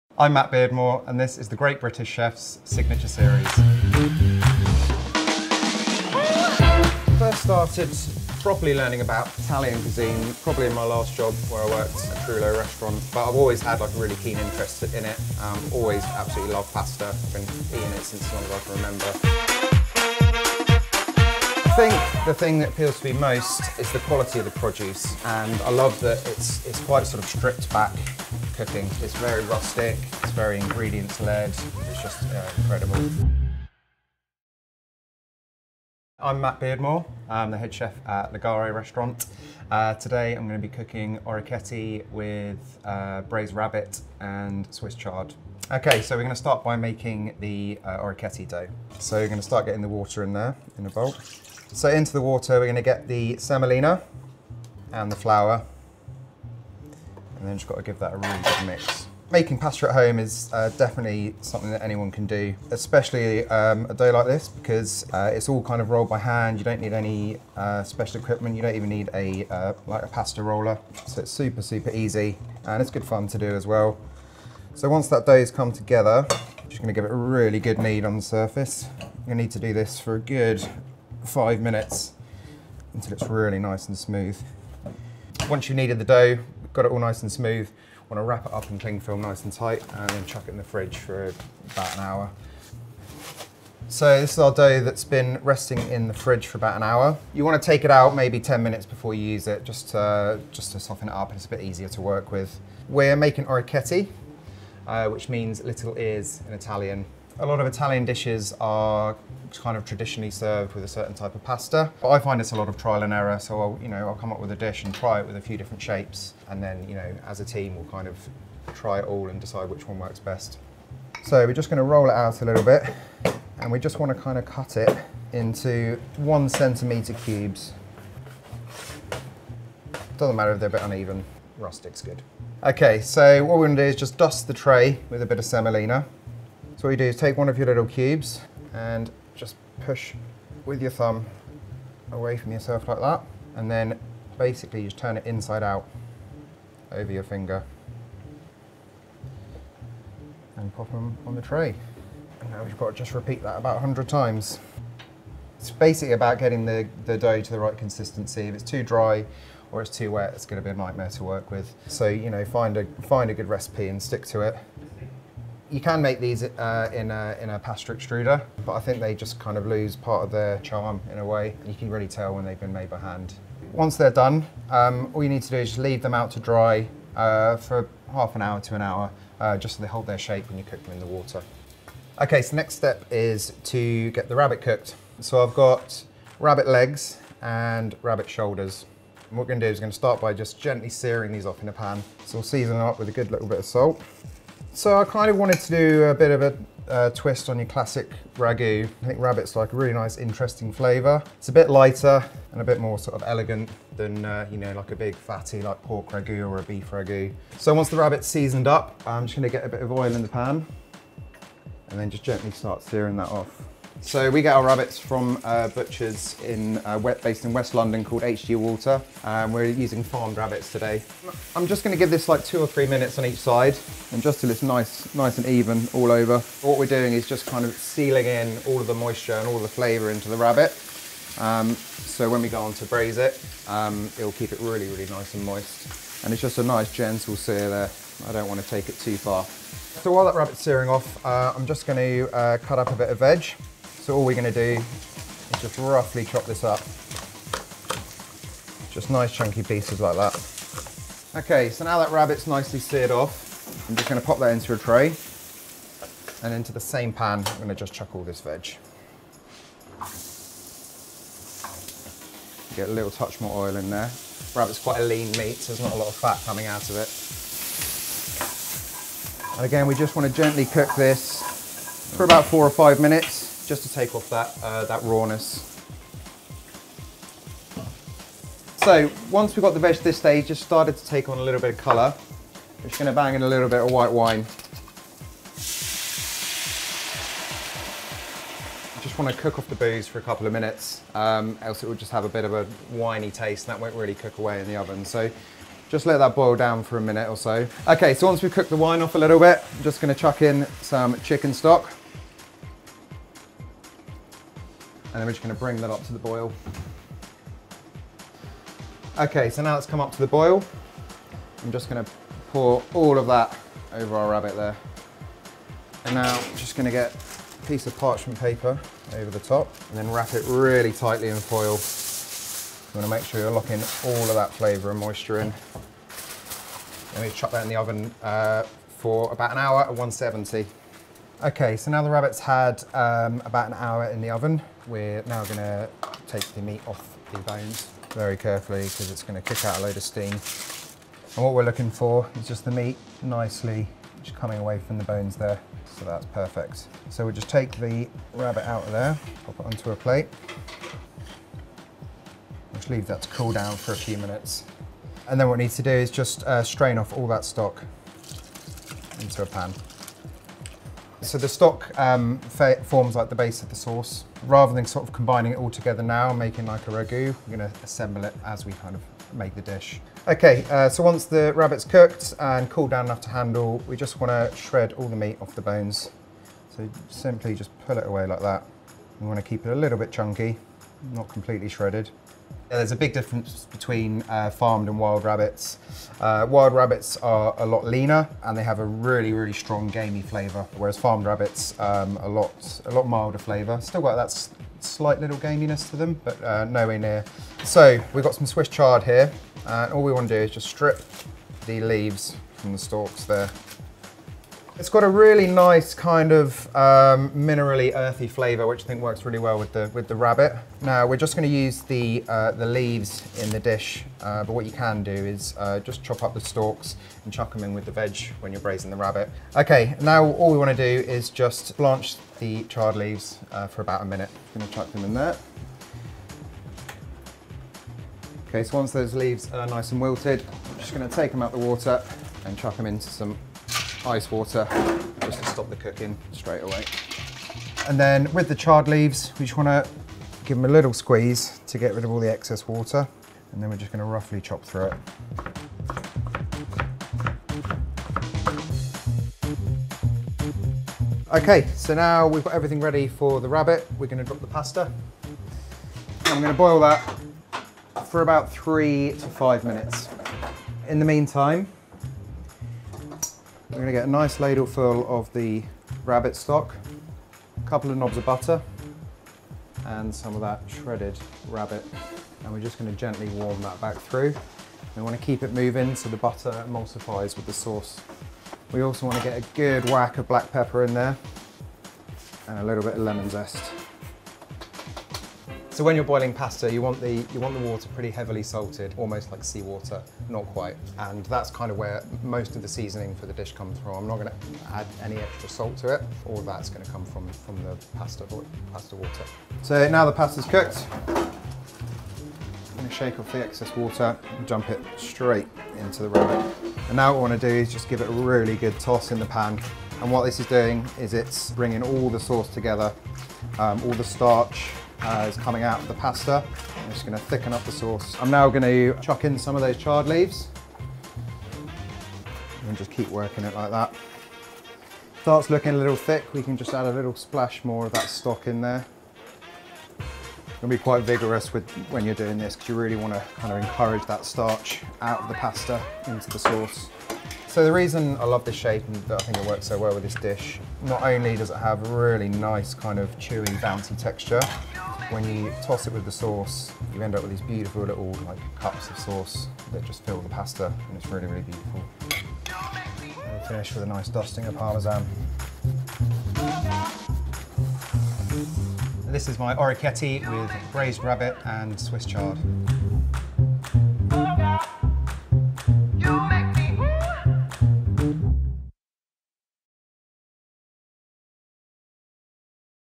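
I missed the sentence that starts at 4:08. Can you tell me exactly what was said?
Just nice chunky pieces like that.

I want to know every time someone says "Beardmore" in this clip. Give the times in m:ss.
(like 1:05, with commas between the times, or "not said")
0:00, 0:36.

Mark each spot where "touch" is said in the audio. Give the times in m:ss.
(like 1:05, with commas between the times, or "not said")
4:23.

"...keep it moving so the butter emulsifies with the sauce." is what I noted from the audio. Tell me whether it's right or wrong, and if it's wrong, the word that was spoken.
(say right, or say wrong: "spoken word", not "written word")
right.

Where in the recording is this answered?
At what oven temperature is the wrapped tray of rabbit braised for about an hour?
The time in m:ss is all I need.
5:29.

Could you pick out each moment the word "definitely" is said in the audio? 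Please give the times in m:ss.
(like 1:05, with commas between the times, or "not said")
1:00.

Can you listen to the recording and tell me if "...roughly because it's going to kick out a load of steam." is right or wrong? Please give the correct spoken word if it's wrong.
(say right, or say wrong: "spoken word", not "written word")
wrong: "carefully", not "roughly".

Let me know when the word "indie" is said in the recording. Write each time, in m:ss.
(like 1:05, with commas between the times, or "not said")
not said.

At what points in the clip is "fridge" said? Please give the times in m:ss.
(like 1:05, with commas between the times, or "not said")
1:30, 1:36.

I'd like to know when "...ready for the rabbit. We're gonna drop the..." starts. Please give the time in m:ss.
7:32.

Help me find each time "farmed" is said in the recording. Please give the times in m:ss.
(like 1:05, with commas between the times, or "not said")
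3:40, 6:24, 6:30.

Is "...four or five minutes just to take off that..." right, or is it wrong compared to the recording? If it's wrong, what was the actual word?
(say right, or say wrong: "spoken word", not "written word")
right.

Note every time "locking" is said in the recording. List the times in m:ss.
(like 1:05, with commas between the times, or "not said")
5:23.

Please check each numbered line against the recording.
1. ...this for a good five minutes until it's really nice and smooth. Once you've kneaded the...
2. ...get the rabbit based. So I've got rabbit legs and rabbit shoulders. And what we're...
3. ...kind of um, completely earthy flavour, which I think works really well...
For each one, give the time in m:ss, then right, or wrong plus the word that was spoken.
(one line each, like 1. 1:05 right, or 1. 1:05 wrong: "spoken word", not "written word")
1. 1:19 right
2. 3:04 wrong: "cooked", not "based"
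3. 6:45 wrong: "minerally", not "completely".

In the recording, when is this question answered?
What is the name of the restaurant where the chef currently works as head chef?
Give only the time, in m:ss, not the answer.
0:38.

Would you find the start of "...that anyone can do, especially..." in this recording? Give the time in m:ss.
1:01.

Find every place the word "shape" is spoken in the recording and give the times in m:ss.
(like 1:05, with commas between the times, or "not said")
1:55, 3:00, 8:58.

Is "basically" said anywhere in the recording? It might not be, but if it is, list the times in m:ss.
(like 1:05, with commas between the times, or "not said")
2:24, 2:35.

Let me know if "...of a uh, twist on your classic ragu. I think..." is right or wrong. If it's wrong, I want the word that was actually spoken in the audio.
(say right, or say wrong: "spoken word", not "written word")
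right.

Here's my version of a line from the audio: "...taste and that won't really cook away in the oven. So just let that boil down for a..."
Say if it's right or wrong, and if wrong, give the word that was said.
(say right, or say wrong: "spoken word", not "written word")
right.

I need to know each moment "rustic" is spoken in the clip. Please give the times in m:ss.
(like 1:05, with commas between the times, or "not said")
0:29, 2:11.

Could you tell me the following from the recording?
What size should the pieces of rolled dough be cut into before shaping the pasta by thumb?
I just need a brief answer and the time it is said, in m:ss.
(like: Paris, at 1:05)
1 centimeter cubes, at 2:06.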